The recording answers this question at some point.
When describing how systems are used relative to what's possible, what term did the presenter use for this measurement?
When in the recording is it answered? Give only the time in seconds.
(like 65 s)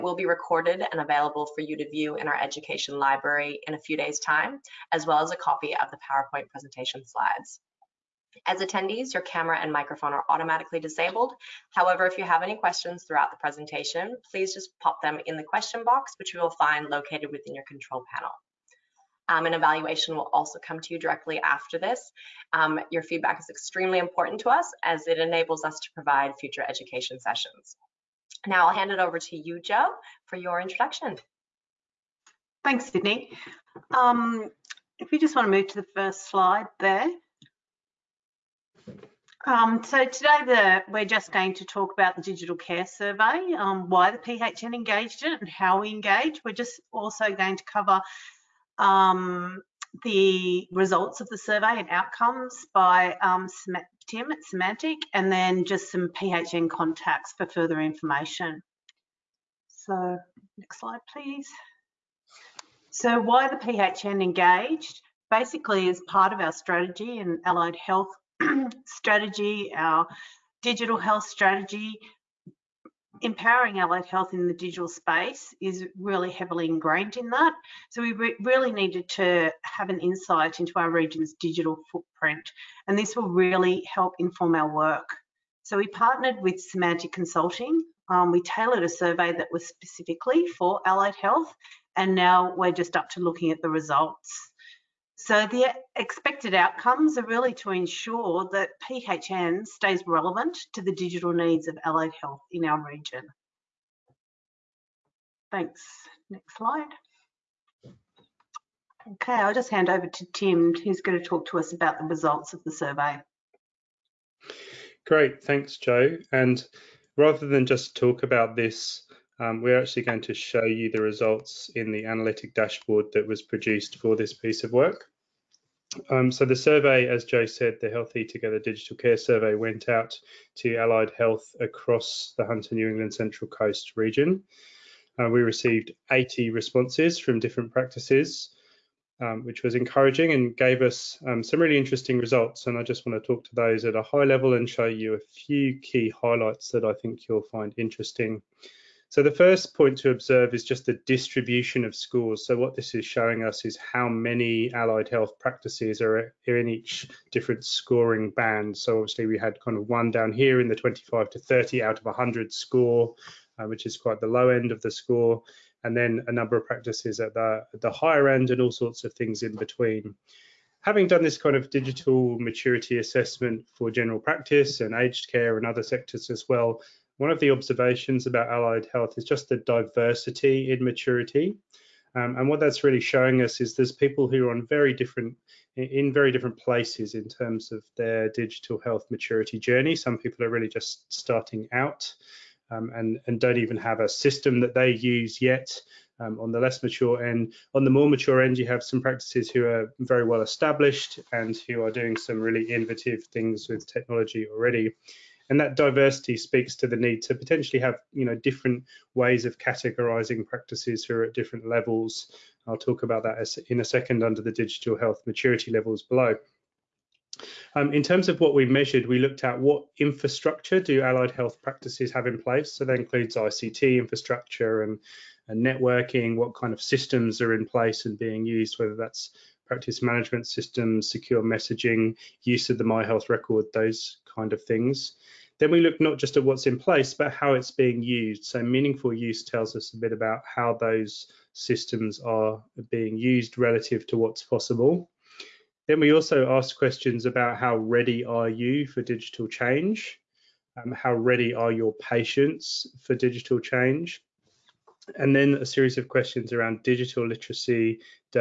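238 s.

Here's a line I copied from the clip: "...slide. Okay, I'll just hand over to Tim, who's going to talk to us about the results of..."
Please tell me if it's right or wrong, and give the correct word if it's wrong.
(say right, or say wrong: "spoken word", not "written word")
right.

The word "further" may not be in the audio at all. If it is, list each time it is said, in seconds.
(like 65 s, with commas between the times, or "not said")
57 s.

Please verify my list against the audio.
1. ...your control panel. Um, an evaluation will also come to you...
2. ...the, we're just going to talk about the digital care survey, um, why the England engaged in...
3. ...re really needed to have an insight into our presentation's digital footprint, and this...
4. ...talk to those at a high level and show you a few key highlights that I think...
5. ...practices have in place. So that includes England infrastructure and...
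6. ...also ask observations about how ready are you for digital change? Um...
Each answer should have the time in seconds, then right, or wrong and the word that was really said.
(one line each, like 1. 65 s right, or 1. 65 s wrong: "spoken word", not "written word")
1. 17 s right
2. 40 s wrong: "PHN", not "England"
3. 78 s wrong: "region", not "presentation"
4. 143 s right
5. 221 s wrong: "ICT", not "England"
6. 246 s wrong: "questions", not "observations".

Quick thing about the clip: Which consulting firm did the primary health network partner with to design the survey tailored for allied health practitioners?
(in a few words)
Semantic Consulting.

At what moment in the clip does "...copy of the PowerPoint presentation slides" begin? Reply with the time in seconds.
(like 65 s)
5 s.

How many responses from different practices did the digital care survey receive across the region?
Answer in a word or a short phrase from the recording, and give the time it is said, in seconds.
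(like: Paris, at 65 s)
80, at 136 s.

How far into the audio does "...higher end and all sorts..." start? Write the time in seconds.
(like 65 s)
167 s.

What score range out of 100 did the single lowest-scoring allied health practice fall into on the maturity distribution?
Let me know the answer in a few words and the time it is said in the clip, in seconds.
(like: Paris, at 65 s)
25 to 30, at 160 s.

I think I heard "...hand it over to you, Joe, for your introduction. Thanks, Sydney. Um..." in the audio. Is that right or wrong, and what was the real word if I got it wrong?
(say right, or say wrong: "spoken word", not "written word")
right.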